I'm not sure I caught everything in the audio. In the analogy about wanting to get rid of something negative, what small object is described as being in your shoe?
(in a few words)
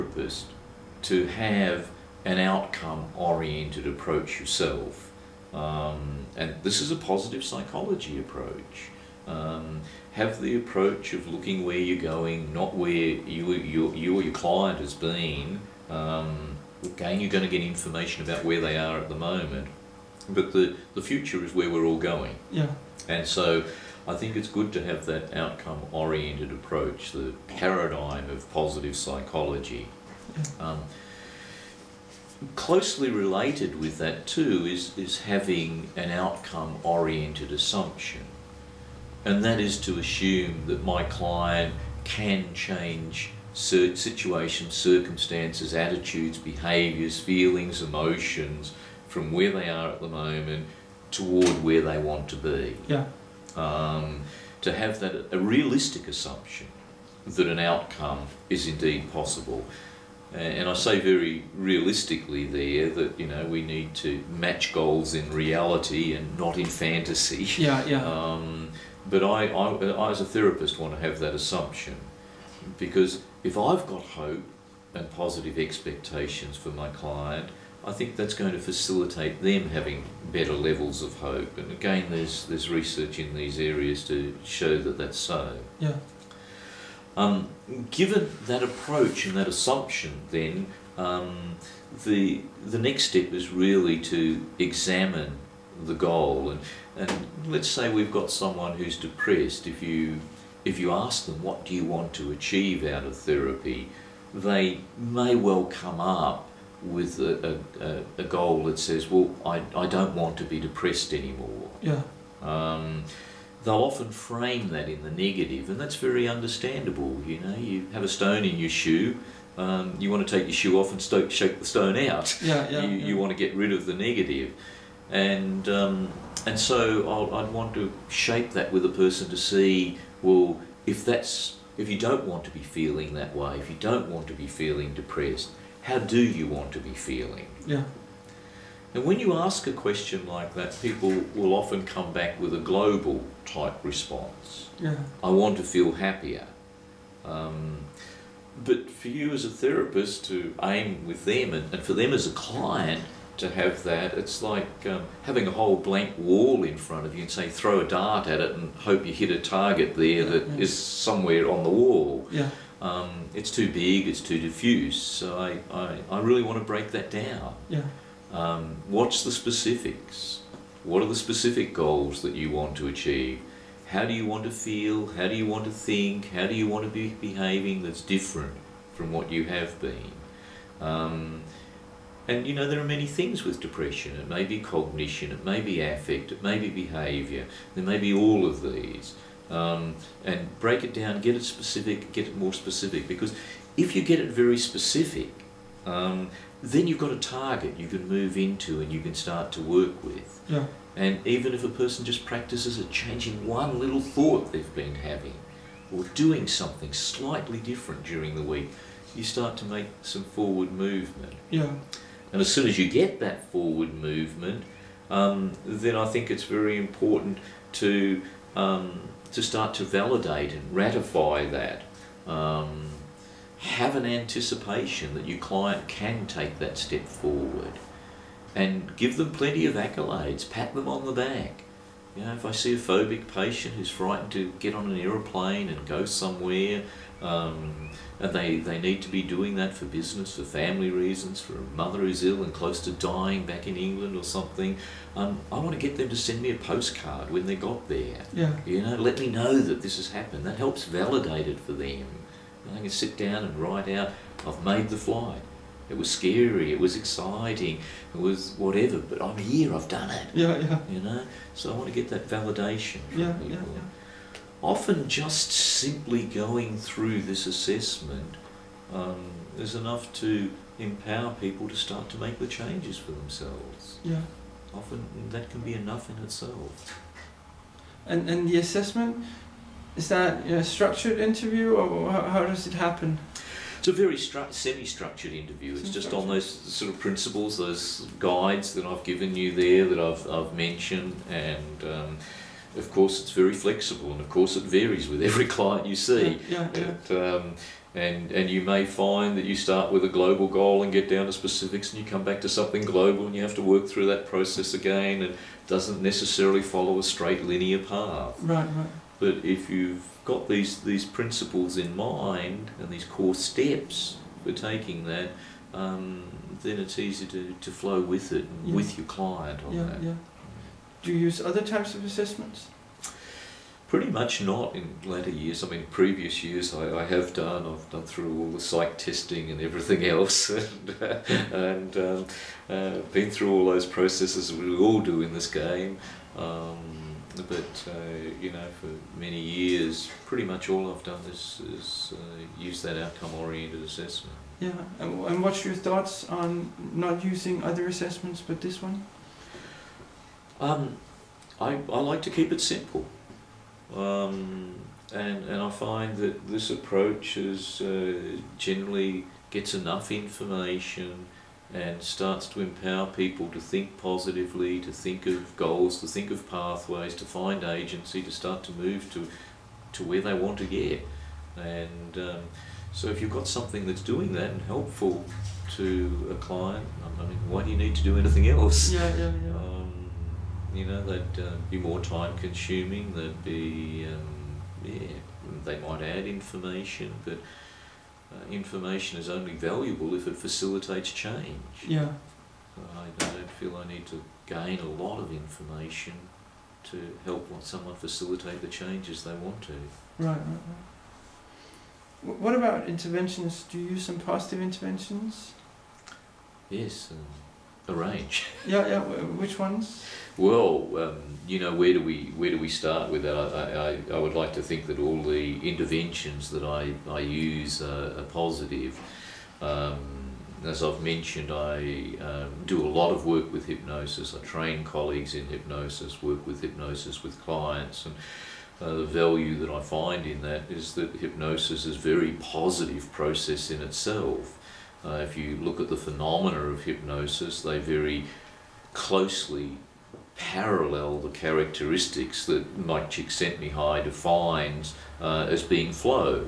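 a stone.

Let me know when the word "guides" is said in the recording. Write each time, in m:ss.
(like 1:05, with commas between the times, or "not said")
4:48.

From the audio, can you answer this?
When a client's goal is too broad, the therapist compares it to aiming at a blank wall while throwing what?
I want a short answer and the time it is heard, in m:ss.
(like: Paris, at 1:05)
a dart, at 2:37.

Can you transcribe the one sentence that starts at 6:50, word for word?
Well, um, you know, where do we where do we start with that?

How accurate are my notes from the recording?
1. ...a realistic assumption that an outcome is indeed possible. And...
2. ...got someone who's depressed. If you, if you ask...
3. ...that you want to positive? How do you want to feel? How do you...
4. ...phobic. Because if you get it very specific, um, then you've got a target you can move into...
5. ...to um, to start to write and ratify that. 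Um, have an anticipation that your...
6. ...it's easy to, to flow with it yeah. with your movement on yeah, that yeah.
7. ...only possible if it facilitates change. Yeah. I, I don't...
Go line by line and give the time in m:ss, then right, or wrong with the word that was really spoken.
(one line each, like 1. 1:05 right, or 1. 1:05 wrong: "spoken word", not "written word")
1. 0:55 right
2. 1:38 right
3. 2:52 wrong: "achieve", not "positive"
4. 3:12 wrong: "specific", not "phobic"
5. 3:37 wrong: "validate", not "write"
6. 5:16 wrong: "client", not "movement"
7. 6:29 wrong: "valuable", not "possible".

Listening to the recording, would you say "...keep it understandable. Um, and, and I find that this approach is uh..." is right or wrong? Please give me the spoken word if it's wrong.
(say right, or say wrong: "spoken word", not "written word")
wrong: "simple", not "understandable".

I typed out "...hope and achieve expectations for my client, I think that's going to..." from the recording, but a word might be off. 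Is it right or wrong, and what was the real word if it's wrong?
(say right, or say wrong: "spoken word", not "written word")
wrong: "positive", not "achieve".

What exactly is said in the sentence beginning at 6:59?
Um, as I've mentioned, I um, do a lot of work with hypnosis.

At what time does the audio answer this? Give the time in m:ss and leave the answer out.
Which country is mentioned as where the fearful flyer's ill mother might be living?
4:03.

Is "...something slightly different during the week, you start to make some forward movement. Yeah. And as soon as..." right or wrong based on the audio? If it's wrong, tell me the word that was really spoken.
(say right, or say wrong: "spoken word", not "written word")
right.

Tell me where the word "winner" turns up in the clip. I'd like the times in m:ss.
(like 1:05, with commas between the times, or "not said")
not said.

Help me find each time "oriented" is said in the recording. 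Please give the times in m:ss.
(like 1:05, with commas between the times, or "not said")
0:03, 0:25, 0:36, 5:42.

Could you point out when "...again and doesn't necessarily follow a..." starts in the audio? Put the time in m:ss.
5:04.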